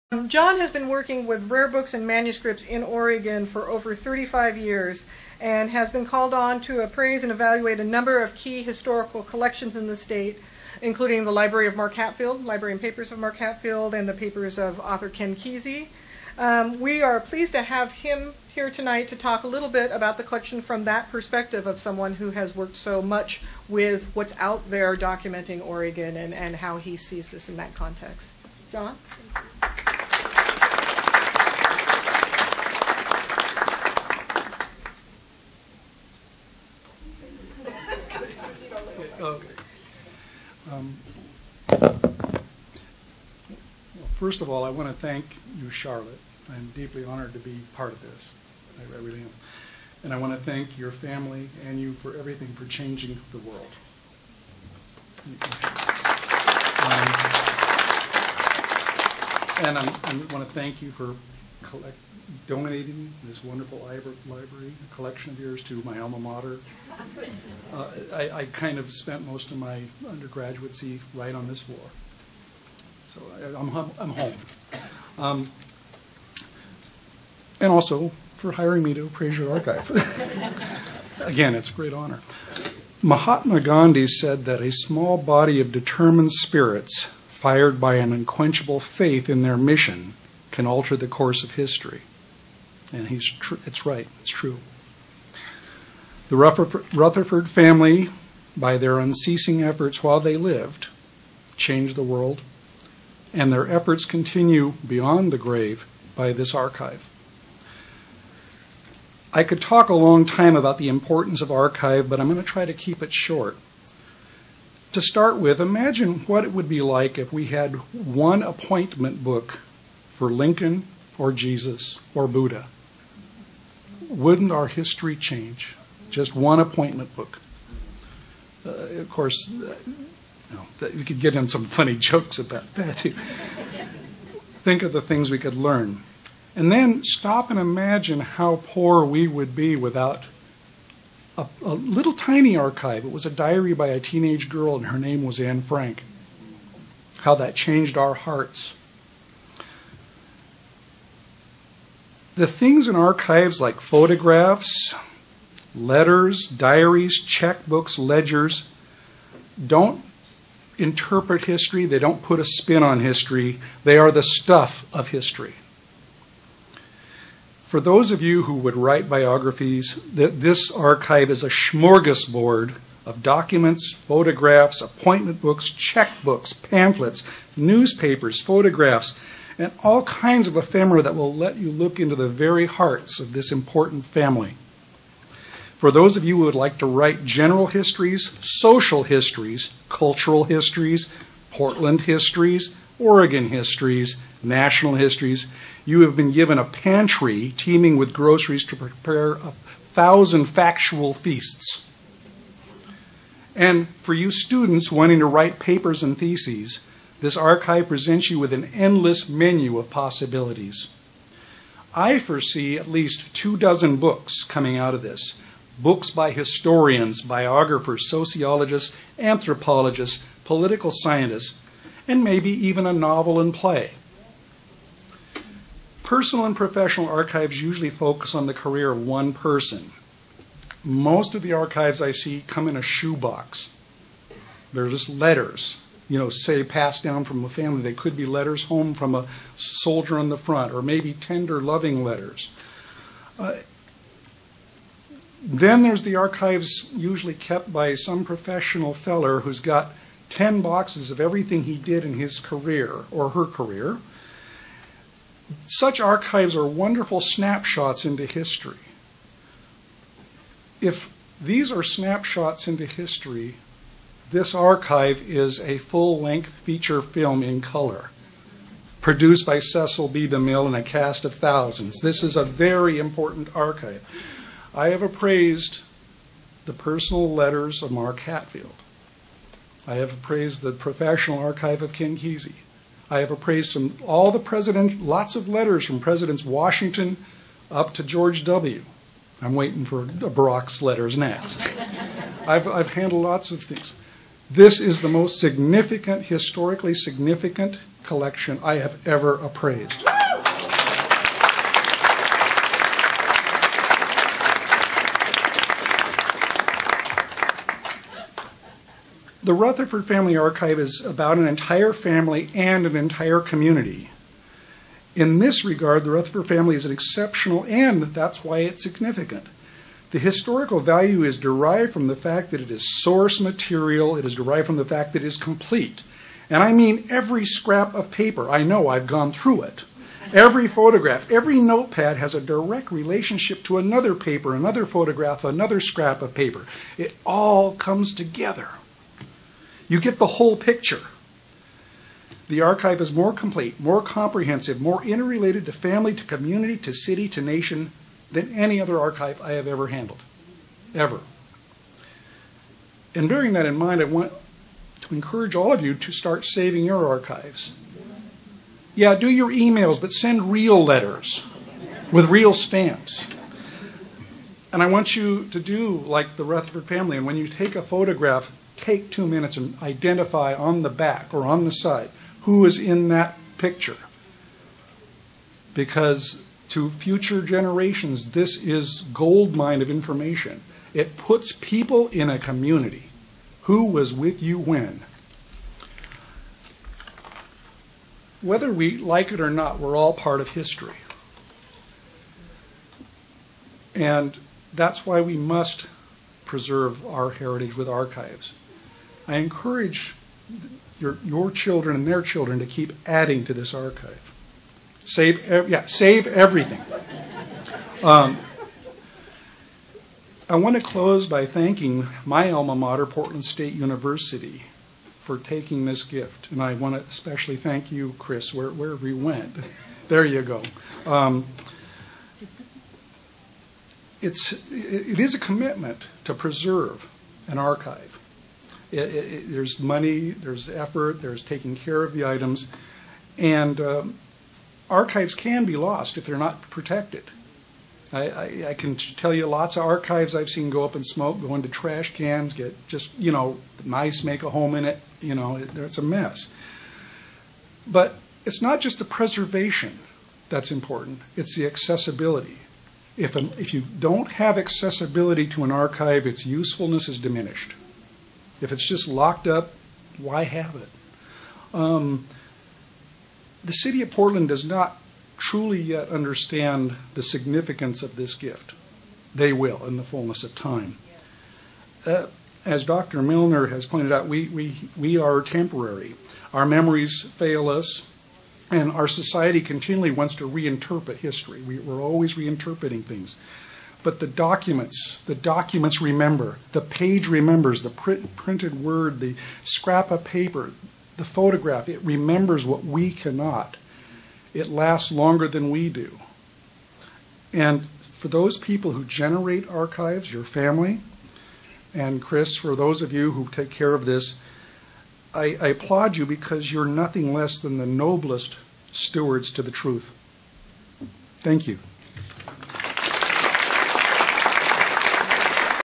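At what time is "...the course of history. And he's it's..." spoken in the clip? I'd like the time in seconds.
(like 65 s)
90 s.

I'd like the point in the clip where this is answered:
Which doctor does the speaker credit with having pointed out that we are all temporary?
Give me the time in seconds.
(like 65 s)
472 s.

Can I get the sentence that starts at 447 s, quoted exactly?
But it's not just the preservation that's important, it's the accessibility.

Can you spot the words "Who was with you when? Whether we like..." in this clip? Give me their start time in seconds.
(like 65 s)
383 s.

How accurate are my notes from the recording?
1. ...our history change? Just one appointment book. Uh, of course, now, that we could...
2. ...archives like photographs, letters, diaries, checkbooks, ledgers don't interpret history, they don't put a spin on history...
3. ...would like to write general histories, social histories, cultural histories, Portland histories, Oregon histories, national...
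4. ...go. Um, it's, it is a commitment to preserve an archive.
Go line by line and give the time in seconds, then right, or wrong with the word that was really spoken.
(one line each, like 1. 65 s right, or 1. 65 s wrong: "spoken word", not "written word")
1. 124 s right
2. 152 s right
3. 186 s right
4. 420 s right.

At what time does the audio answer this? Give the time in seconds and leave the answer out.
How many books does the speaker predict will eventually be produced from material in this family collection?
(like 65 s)
213 s.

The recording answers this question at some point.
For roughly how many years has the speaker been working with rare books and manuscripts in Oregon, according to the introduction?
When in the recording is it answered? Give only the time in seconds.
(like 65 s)
3 s.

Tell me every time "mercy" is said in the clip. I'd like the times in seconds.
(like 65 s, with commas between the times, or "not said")
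not said.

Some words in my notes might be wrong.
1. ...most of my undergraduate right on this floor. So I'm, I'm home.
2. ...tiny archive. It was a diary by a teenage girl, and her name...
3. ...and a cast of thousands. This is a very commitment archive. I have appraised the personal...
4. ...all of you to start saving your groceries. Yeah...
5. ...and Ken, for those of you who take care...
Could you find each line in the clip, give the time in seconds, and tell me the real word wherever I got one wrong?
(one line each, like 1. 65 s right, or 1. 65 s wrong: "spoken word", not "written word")
1. 69 s right
2. 142 s right
3. 270 s wrong: "important", not "commitment"
4. 355 s wrong: "archives", not "groceries"
5. 501 s wrong: "Cris", not "Ken".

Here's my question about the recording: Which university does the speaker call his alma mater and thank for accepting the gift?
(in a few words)
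Portland State University.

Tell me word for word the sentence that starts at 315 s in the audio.
In this regard, the Rutherford family is an exceptional and that's why it's significant.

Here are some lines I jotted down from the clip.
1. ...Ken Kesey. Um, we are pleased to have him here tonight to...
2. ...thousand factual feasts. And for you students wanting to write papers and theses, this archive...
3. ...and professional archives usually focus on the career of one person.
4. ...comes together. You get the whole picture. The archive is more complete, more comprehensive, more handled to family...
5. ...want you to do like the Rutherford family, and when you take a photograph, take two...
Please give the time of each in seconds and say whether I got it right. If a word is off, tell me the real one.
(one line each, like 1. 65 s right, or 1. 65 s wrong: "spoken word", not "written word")
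1. 15 s right
2. 199 s right
3. 226 s right
4. 337 s wrong: "interrelated", not "handled"
5. 364 s right.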